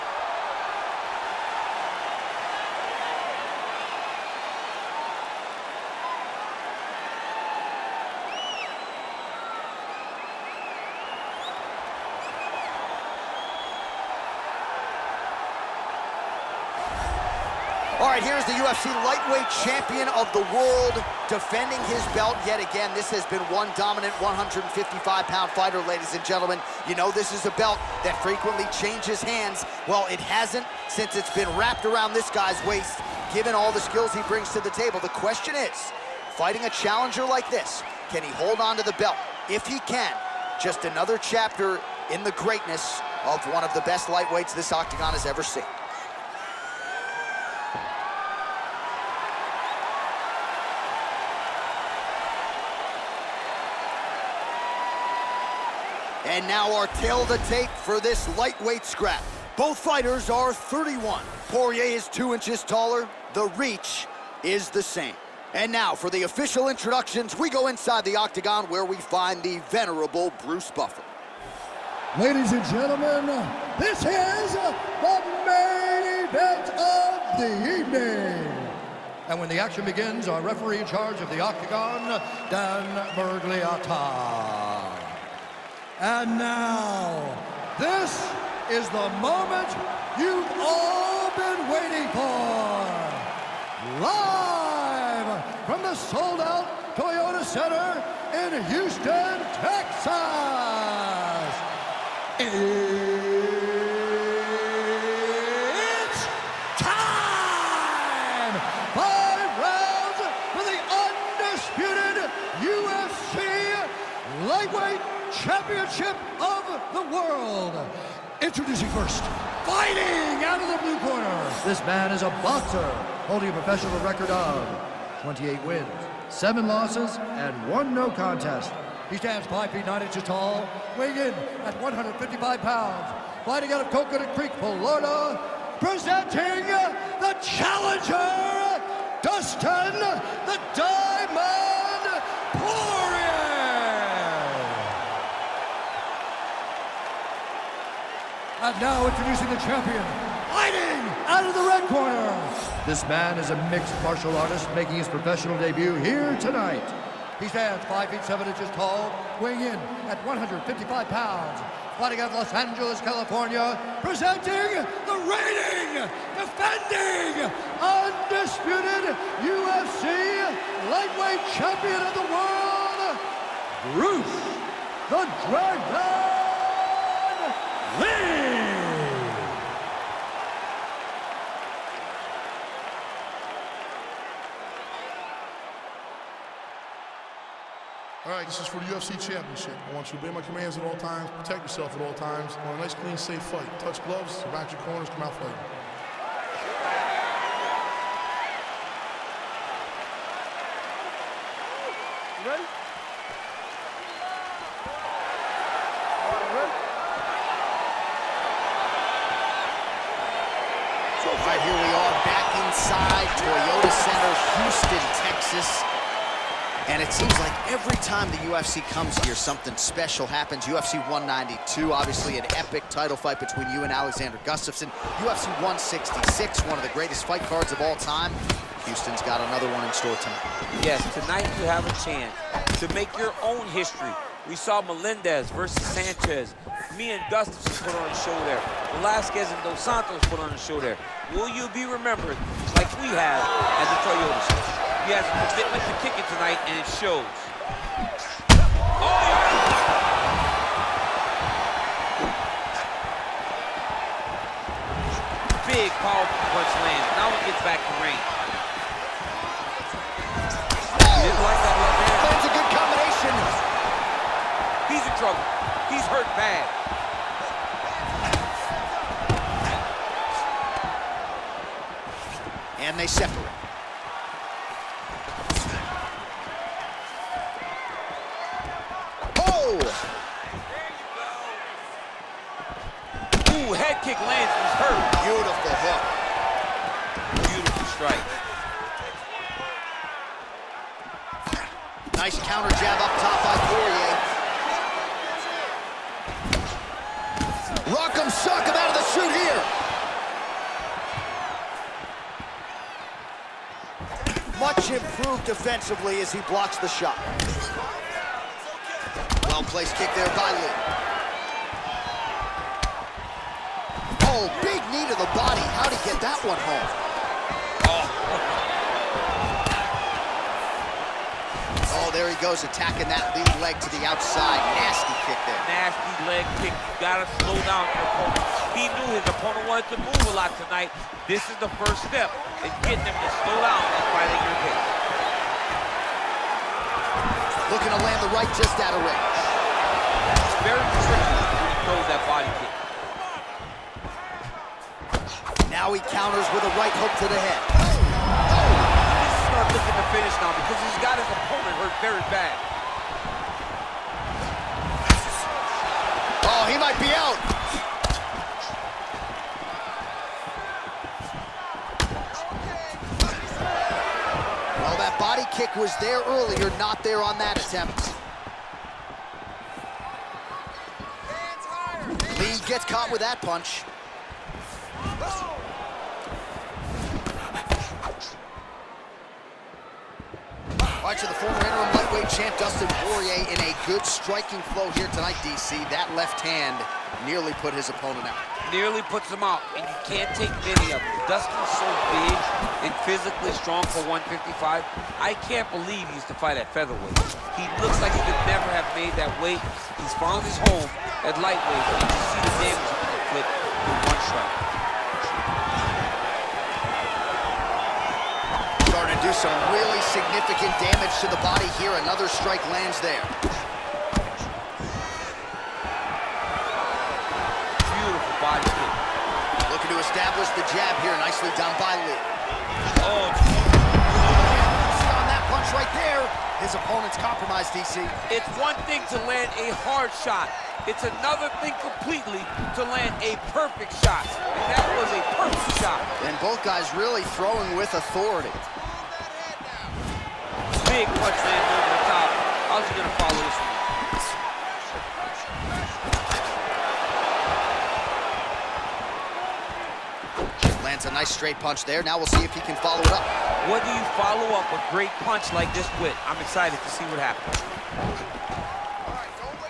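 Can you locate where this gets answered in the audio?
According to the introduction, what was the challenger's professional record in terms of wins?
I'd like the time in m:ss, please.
2:05.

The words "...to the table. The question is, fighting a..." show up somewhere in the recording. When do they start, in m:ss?
0:34.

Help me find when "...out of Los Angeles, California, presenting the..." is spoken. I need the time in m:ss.
2:42.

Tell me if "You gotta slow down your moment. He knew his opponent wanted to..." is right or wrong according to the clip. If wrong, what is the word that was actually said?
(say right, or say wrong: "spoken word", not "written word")
wrong: "opponent", not "moment".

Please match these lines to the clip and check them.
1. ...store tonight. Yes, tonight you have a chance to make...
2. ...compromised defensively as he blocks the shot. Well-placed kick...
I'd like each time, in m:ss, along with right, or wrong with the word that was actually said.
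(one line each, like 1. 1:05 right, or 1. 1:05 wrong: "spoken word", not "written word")
1. 3:49 right
2. 5:04 wrong: "improved", not "compromised".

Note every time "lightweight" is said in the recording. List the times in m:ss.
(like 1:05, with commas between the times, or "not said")
0:19, 0:44, 0:58, 2:50, 6:21, 6:41.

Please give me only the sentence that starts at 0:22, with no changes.
This has been one dominant 155-pound fighter, ladies and gentlemen.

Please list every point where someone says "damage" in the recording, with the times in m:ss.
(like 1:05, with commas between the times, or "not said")
6:42, 6:50.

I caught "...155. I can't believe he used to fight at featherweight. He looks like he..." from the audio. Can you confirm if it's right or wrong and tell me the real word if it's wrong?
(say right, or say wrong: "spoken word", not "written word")
right.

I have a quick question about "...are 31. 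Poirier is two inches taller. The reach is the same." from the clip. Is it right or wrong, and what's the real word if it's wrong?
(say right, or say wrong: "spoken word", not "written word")
right.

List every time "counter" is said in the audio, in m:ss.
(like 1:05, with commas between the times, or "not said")
4:52, 5:46.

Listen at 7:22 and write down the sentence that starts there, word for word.
How's he gonna follow this one?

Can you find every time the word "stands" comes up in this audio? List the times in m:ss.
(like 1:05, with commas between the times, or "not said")
2:09, 2:37.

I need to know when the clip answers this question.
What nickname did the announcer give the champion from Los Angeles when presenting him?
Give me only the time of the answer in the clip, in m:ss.
2:55.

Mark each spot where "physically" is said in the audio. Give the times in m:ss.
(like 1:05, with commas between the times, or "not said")
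6:33.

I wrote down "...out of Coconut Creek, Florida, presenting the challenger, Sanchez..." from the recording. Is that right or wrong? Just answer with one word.
wrong.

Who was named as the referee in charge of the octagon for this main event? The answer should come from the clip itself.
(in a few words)
Dan Miragliotta.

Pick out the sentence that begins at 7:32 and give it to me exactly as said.
Now we'll see if he can follow it up.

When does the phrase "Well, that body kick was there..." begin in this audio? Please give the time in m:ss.
6:04.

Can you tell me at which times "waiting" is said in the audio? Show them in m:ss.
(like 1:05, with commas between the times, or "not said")
1:31.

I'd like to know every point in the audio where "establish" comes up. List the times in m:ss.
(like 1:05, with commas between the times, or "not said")
6:59.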